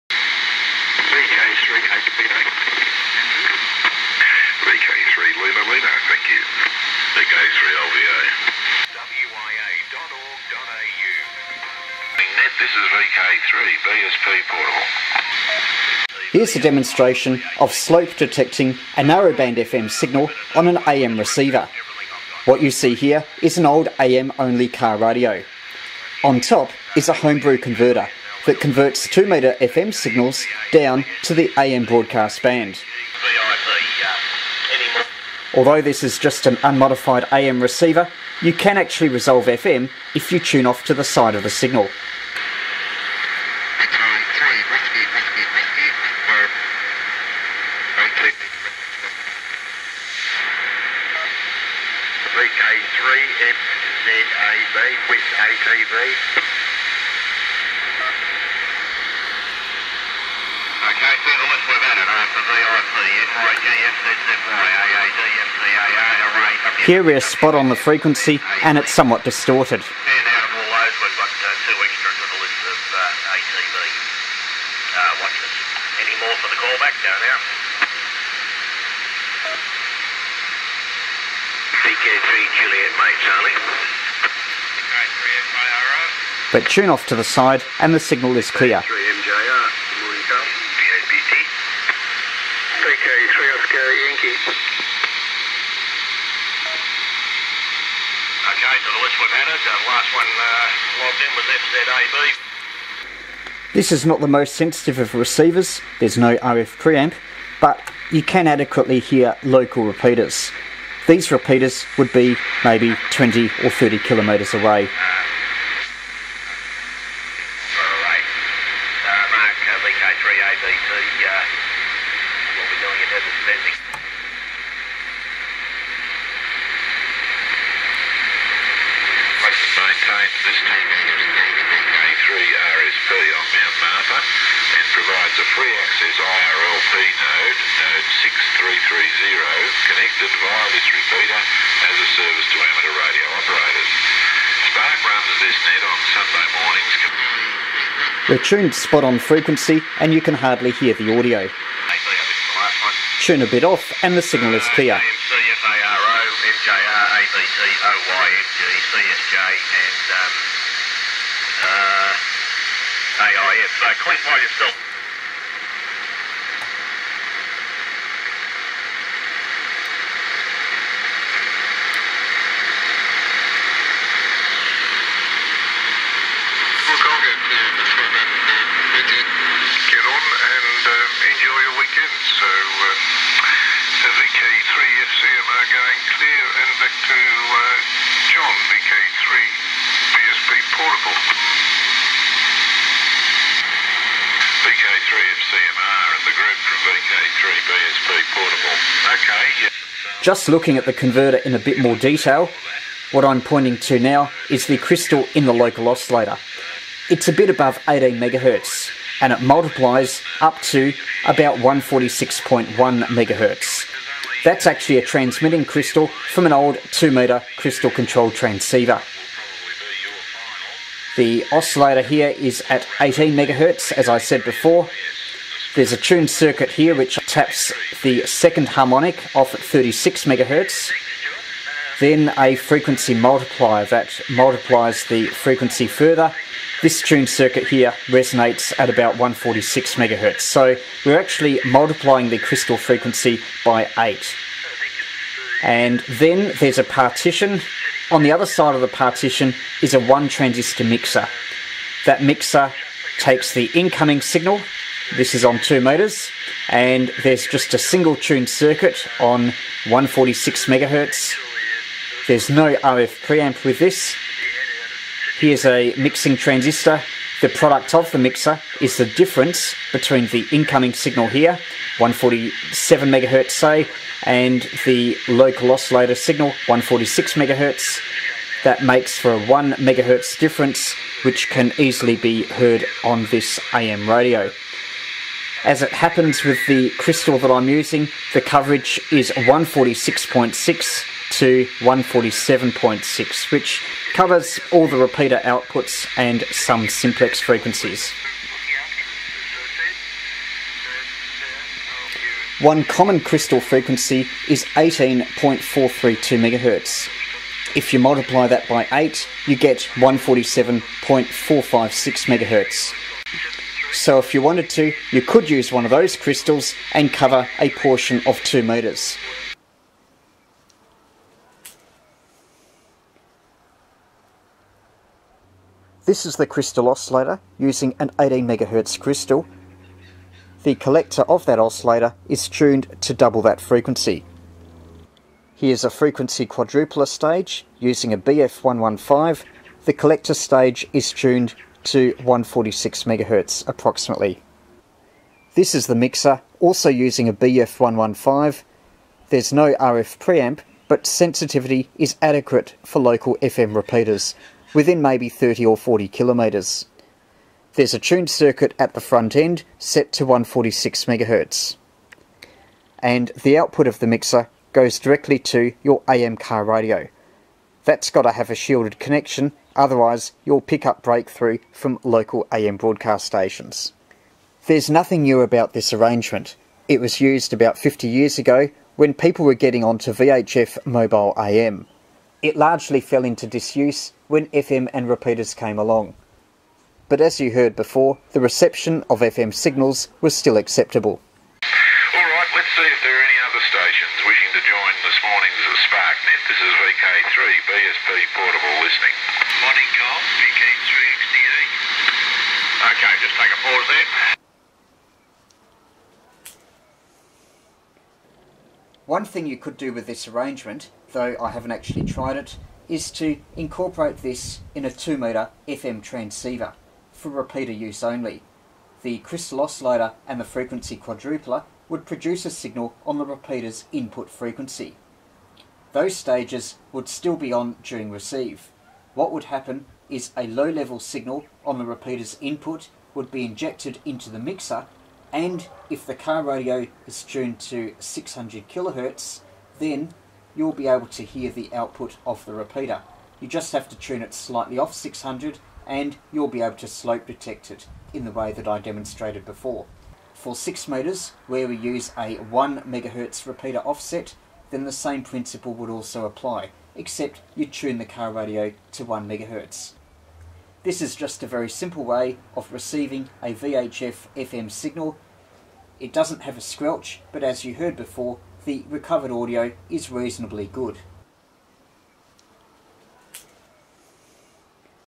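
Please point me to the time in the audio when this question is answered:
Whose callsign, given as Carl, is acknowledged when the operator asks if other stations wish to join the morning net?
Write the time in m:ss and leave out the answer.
6:40.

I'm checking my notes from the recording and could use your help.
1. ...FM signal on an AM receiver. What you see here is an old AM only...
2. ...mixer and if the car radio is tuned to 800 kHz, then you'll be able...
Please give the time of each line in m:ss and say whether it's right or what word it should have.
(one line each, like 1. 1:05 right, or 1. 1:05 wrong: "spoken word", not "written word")
1. 0:19 right
2. 7:14 wrong: "600", not "800".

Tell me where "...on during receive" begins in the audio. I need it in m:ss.
7:07.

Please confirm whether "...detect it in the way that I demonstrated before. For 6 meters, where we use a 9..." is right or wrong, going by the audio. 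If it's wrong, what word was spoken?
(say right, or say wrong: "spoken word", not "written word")
wrong: "1", not "9".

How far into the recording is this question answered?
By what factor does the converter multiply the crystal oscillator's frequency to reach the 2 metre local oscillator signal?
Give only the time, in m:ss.
4:01.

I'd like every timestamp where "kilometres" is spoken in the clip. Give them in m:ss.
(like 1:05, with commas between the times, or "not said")
1:53, 5:56.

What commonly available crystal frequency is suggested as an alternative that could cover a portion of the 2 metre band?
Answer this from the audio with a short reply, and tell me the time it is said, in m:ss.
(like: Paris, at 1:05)
18.432 MHz, at 5:04.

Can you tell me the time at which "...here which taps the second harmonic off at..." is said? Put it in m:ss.
3:46.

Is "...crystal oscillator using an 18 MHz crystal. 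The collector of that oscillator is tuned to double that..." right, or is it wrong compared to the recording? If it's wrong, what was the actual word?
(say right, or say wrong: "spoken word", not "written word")
right.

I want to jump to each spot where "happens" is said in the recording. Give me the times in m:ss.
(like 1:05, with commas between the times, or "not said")
4:45, 7:09.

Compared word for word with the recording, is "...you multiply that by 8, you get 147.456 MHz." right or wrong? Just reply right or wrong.
right.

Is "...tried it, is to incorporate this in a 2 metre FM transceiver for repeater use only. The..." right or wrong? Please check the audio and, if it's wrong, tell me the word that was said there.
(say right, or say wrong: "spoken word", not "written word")
right.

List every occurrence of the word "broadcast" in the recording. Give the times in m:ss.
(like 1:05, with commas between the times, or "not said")
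0:31, 6:12.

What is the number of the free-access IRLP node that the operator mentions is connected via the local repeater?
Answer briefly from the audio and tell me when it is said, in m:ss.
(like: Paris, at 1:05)
6330, at 2:17.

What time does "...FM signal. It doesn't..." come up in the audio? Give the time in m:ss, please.
7:44.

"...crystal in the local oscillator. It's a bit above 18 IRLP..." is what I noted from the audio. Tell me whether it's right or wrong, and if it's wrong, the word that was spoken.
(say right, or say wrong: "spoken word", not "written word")
wrong: "MHz", not "IRLP".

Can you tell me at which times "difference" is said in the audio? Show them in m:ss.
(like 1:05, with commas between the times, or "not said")
4:29, 4:40.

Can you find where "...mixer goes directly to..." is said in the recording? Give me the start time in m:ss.
6:04.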